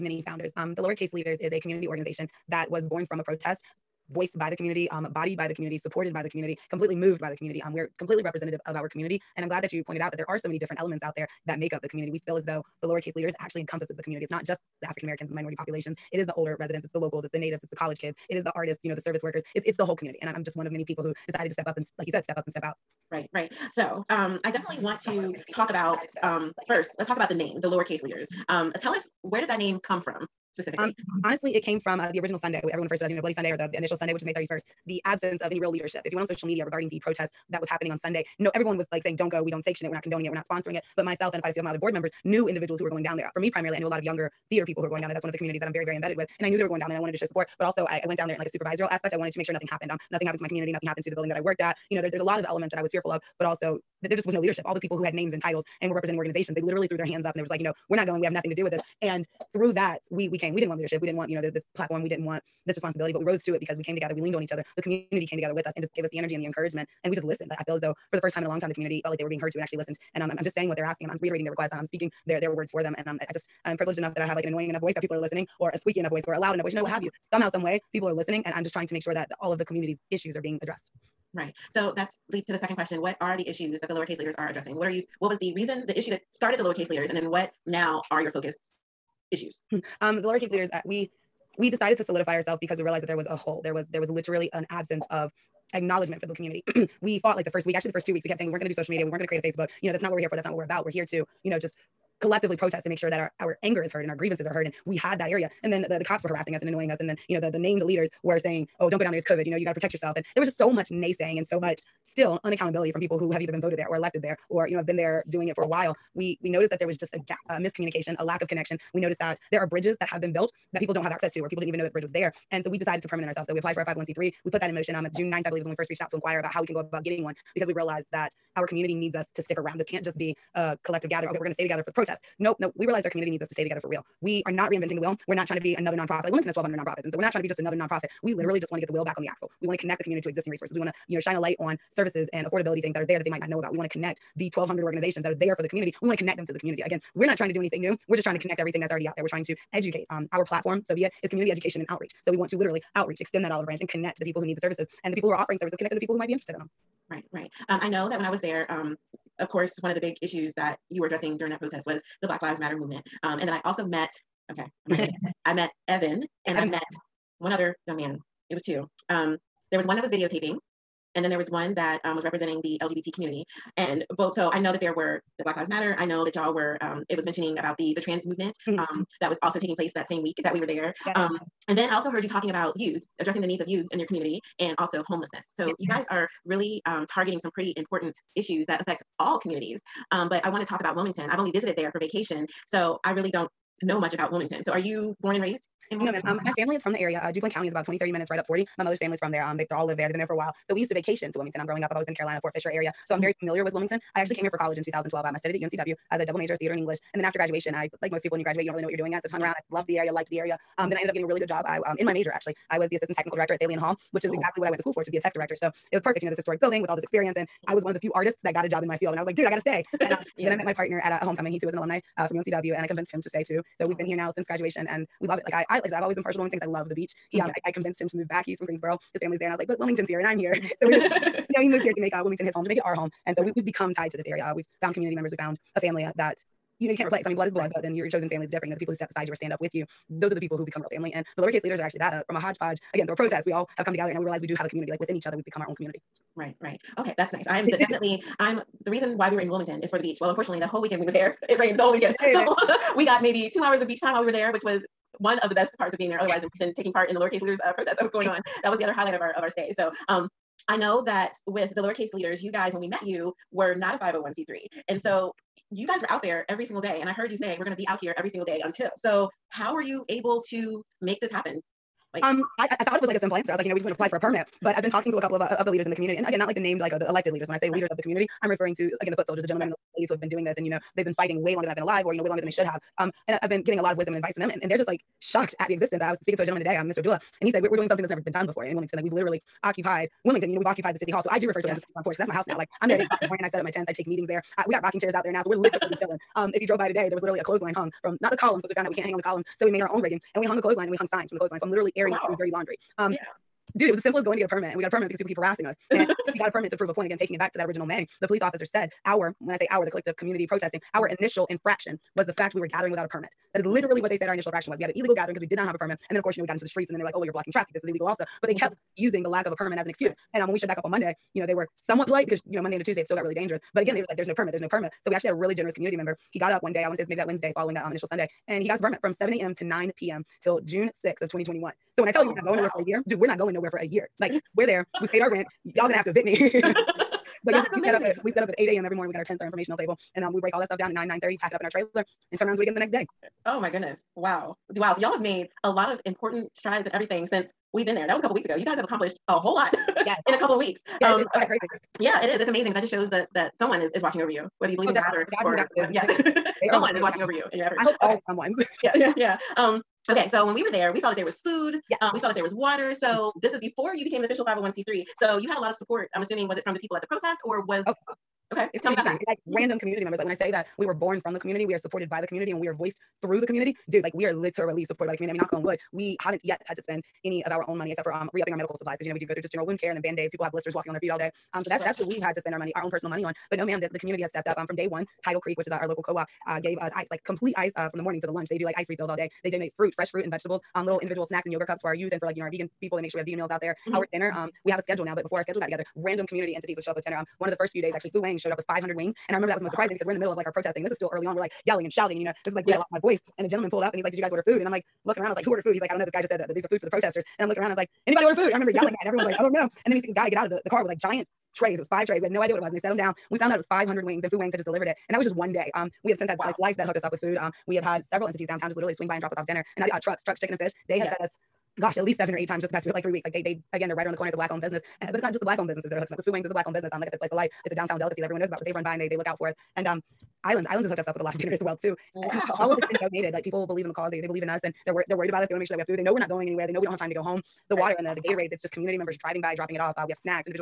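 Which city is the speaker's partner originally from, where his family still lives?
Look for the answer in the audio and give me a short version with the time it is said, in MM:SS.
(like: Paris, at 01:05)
Greensboro, at 03:48.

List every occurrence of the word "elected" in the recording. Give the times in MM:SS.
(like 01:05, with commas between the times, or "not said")
01:53, 04:37.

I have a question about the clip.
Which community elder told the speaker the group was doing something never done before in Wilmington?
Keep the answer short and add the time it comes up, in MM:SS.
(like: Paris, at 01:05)
Mr. Abdullah, at 04:46.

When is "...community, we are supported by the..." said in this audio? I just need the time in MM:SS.
06:11.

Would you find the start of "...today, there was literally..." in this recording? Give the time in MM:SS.
04:56.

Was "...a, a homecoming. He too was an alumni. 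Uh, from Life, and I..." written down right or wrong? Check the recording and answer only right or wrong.
wrong.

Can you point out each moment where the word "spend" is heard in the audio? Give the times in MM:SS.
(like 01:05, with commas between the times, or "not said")
06:16, 06:22.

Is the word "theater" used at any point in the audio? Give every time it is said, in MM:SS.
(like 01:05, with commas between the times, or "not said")
00:44, 03:26.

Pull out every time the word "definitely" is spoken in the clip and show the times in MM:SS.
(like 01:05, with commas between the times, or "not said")
00:24, 04:07, 05:54.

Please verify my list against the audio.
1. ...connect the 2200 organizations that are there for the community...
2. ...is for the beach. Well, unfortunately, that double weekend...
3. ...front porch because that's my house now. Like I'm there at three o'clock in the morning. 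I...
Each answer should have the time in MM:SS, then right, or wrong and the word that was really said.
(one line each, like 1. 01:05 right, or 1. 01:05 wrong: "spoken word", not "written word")
1. 02:23 wrong: "1200", not "2200"
2. 04:09 wrong: "whole", not "double"
3. 04:51 wrong: "eight", not "three".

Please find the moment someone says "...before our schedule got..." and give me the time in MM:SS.
06:35.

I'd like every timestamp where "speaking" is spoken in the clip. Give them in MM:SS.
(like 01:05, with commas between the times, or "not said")
01:11, 04:46.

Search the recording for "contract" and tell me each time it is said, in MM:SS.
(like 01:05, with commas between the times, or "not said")
not said.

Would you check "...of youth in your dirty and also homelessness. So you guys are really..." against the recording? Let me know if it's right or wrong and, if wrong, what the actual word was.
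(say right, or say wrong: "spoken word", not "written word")
wrong: "community", not "dirty".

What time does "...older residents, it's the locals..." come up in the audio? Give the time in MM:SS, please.
00:16.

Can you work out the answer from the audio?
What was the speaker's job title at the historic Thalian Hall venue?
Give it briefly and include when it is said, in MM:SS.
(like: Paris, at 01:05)
Assistant technical director, at 03:32.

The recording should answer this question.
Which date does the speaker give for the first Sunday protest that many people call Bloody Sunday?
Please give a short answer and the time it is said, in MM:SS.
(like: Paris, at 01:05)
May 31st, at 00:34.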